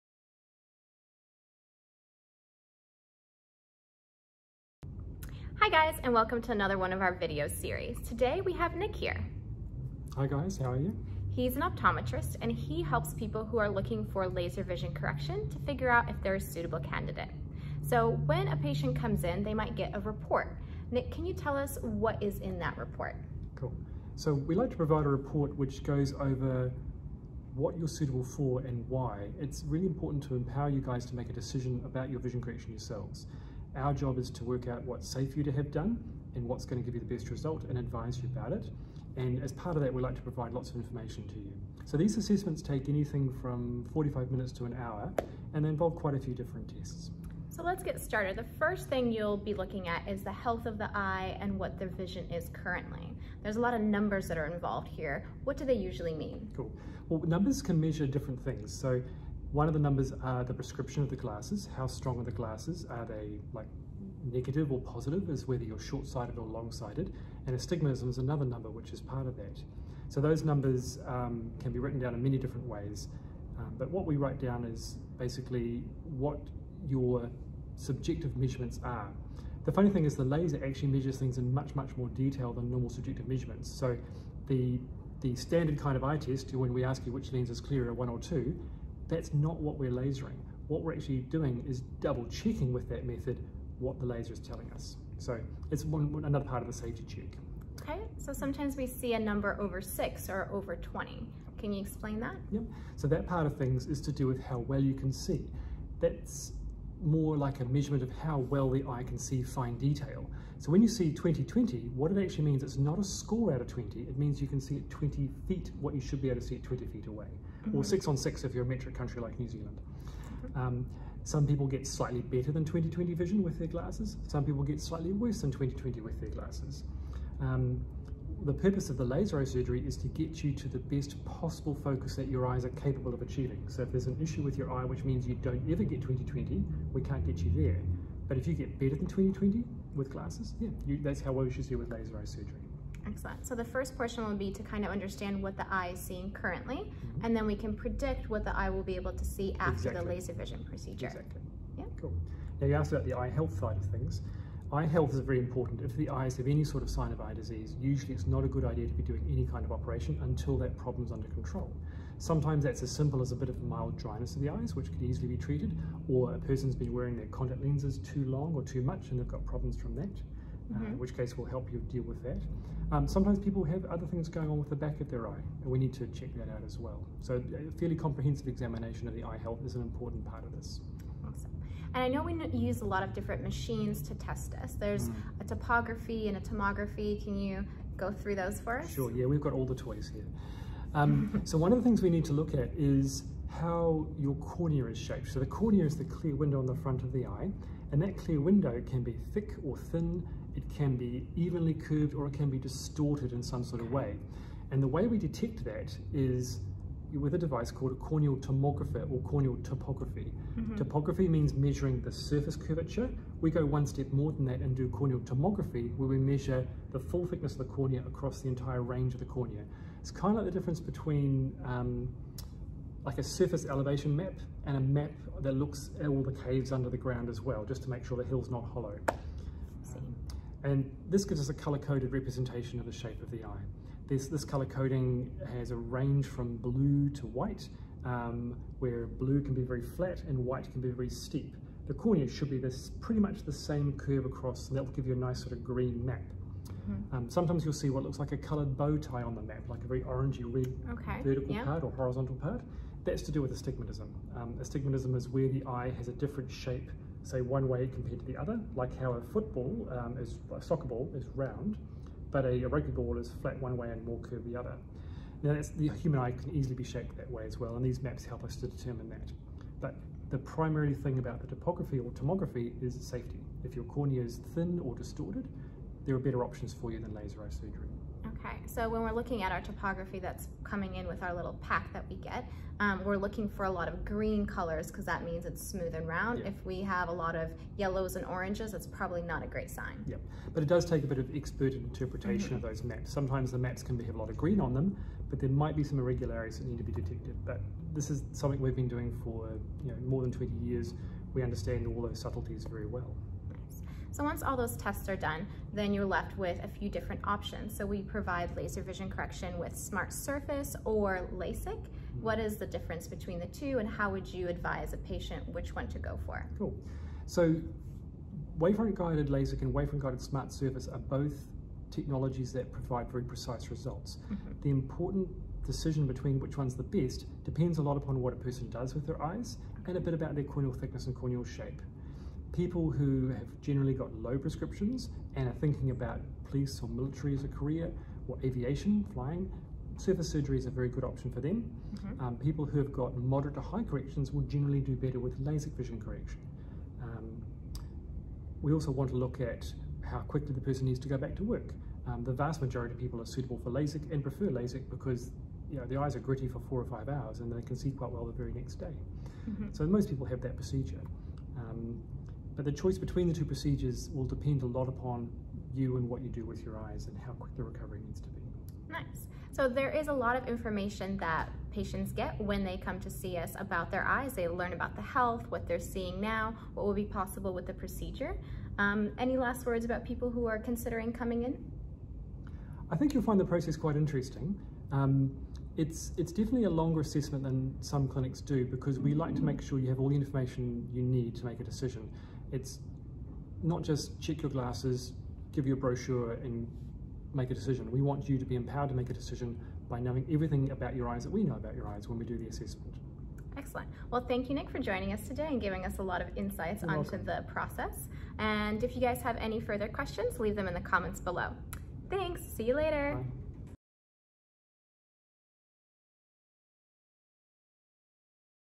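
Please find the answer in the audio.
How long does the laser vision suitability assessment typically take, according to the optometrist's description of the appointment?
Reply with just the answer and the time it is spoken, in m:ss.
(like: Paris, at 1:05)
45 minutes to an hour, at 0:43.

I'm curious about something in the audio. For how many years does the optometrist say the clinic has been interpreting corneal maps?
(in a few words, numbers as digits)
More than 20.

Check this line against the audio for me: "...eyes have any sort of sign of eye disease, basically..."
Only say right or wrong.
wrong.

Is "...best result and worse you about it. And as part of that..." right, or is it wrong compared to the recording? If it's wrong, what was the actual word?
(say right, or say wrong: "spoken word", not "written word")
wrong: "advise", not "worse".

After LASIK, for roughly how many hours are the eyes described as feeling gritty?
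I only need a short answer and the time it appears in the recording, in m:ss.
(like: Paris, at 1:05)
4 or 5 hours, at 5:56.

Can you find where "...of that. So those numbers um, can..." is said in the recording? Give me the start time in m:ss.
1:09.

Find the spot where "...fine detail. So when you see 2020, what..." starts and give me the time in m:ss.
1:49.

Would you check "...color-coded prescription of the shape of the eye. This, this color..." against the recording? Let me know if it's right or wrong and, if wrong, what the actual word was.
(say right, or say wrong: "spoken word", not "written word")
wrong: "representation", not "prescription".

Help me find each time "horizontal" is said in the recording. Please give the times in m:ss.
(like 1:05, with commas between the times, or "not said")
4:11.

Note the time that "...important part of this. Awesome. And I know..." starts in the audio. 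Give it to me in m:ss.
2:59.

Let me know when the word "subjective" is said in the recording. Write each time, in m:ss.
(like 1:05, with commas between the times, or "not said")
1:17, 1:22.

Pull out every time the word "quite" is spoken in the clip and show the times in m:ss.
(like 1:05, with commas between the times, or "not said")
0:45, 5:57, 6:23.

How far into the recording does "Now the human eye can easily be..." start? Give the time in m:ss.
4:25.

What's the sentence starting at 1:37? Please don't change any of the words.
Okay, so sometimes we see a number over six or over 20.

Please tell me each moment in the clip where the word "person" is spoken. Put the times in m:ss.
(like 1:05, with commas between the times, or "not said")
2:46, 5:28, 5:50.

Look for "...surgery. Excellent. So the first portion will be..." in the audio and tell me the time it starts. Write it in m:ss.
2:22.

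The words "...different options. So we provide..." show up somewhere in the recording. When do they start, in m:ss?
5:06.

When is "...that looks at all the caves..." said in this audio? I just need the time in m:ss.
3:45.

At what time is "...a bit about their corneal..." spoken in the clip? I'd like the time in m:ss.
5:29.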